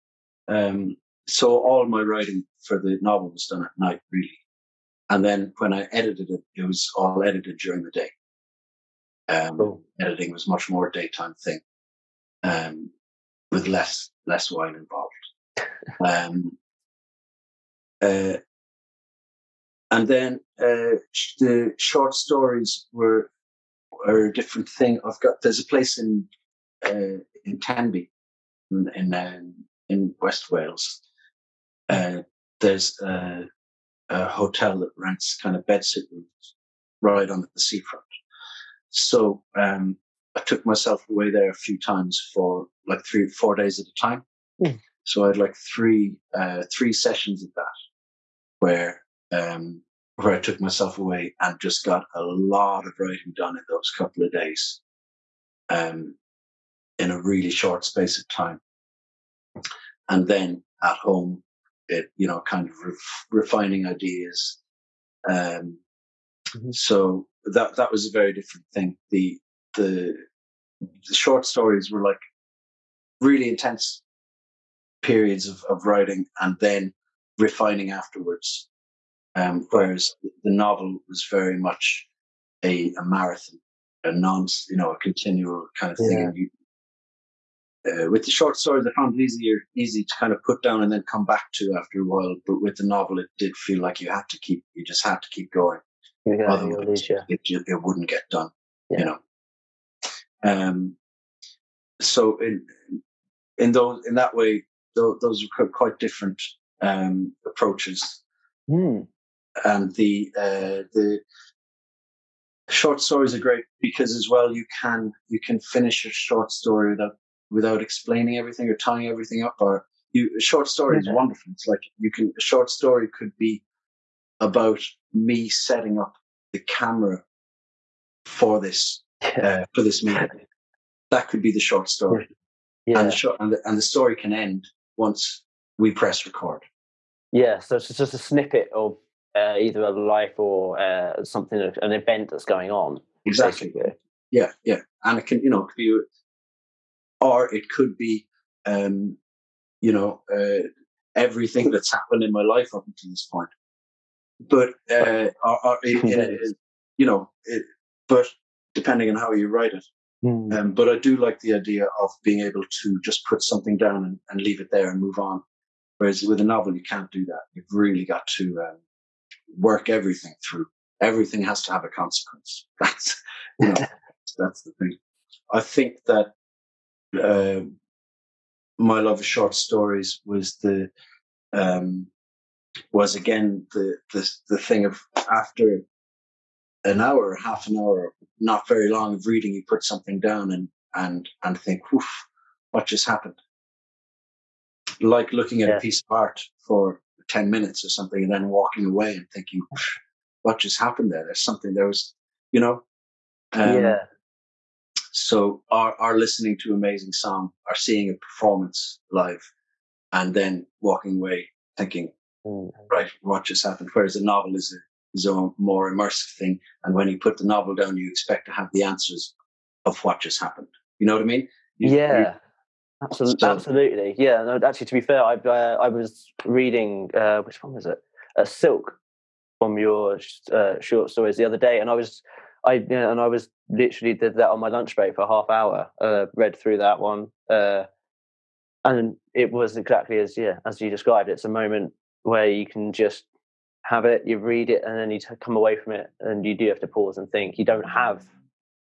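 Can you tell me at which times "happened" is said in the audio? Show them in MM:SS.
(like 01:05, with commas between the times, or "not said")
02:31, 03:13, 03:20, 03:33, 03:40.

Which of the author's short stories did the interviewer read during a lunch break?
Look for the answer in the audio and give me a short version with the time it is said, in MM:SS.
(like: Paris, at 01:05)
Silk, at 03:48.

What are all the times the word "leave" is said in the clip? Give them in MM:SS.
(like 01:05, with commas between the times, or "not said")
02:44.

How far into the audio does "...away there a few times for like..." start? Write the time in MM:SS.
00:41.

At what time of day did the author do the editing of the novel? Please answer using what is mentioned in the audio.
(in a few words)
During the day.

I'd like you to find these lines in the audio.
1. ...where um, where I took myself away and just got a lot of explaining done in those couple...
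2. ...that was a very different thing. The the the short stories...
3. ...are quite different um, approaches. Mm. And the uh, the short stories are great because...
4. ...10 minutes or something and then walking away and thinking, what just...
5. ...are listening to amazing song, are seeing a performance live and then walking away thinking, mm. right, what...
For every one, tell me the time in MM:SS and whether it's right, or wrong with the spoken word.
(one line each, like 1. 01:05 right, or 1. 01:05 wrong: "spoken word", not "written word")
1. 00:48 wrong: "writing", not "explaining"
2. 01:07 right
3. 01:45 right
4. 03:17 right
5. 03:25 right.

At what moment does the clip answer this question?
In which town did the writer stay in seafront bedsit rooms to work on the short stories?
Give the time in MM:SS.
00:27.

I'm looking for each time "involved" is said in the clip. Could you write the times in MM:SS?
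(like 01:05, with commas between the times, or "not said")
00:14.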